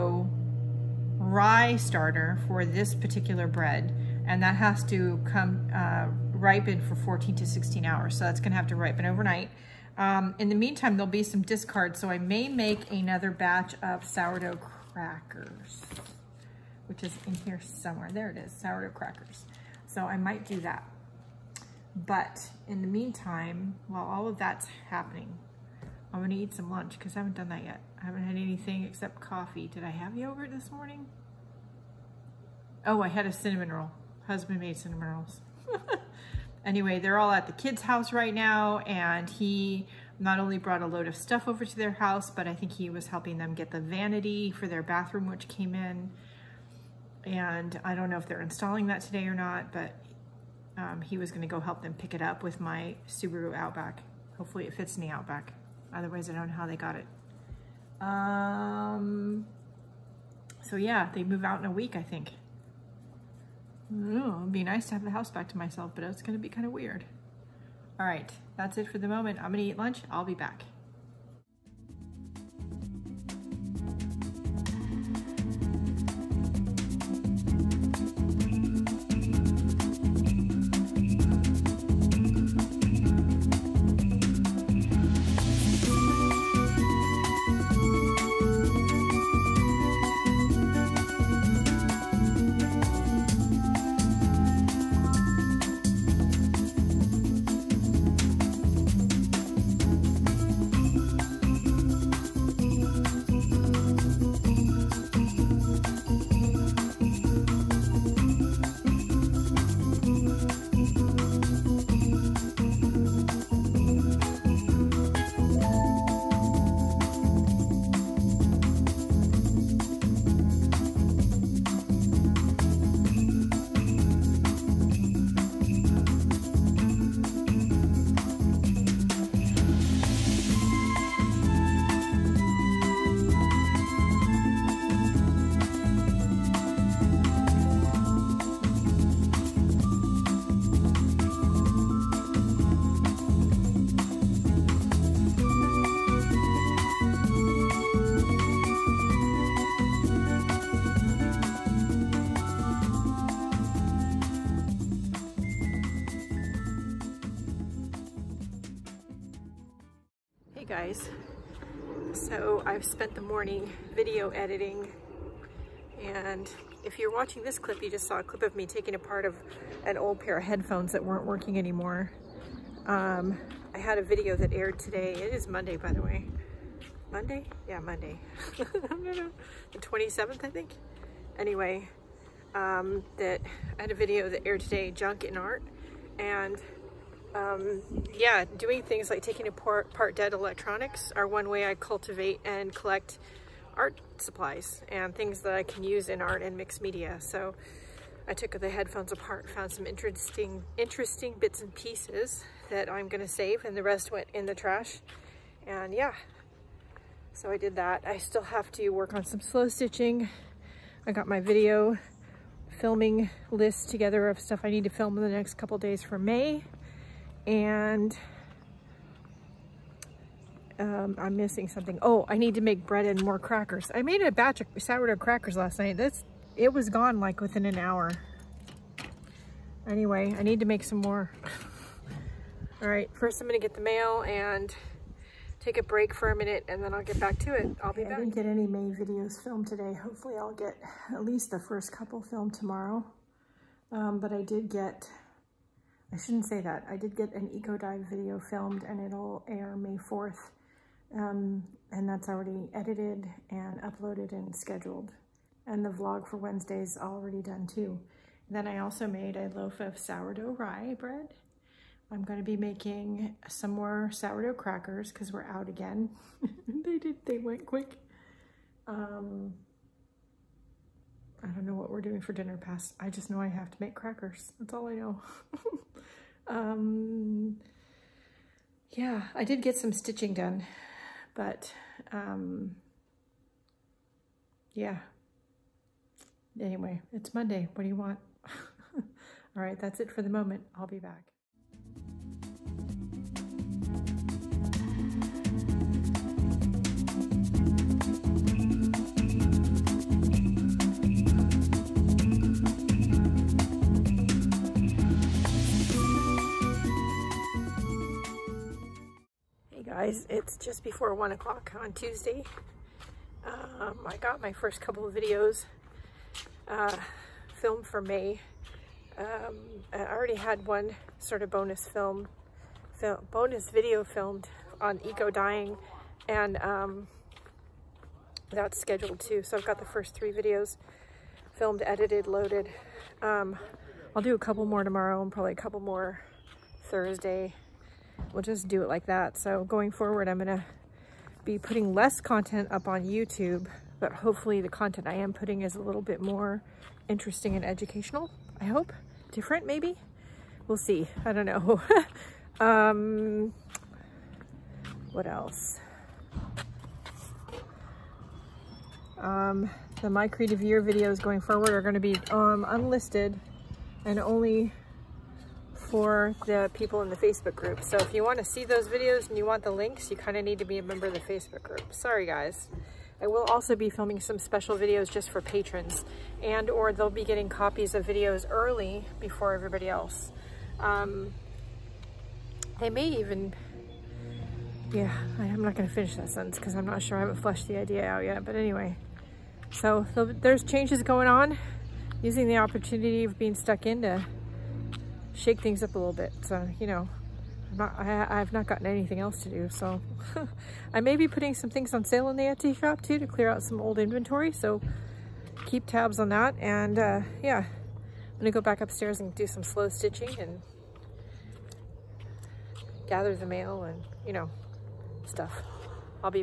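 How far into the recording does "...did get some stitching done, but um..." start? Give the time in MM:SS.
04:39.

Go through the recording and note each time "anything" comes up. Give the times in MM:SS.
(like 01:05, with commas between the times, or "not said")
00:28, 06:38.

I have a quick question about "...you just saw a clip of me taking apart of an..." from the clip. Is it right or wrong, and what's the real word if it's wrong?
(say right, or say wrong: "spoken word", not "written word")
right.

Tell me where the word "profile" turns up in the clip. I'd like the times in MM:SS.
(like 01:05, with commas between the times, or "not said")
not said.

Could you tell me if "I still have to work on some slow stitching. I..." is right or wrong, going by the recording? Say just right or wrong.
right.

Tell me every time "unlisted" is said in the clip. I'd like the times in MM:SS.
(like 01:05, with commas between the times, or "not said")
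06:02.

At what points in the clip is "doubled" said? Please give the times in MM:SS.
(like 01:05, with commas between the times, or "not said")
not said.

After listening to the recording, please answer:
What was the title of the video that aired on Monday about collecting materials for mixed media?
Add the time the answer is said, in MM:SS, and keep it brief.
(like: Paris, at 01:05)
Junk in Art, at 03:04.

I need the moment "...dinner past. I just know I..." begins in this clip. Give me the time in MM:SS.
04:32.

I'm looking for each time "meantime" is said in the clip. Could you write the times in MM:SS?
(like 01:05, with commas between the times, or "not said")
00:10, 00:22.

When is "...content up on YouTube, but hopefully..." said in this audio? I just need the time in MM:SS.
05:42.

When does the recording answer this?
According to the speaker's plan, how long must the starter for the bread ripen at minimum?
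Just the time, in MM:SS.
00:06.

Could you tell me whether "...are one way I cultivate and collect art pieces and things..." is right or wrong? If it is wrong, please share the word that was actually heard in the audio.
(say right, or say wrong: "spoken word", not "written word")
wrong: "supplies", not "pieces".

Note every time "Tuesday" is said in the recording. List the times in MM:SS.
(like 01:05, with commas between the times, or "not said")
05:11.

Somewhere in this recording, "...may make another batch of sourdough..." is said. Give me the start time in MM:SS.
00:12.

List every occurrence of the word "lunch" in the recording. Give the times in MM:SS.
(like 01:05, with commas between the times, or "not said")
00:26, 01:09.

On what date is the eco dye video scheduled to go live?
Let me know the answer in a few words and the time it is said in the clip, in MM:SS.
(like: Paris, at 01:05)
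May 4th, at 04:09.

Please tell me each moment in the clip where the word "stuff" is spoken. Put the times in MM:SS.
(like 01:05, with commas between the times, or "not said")
00:41, 03:34, 06:55.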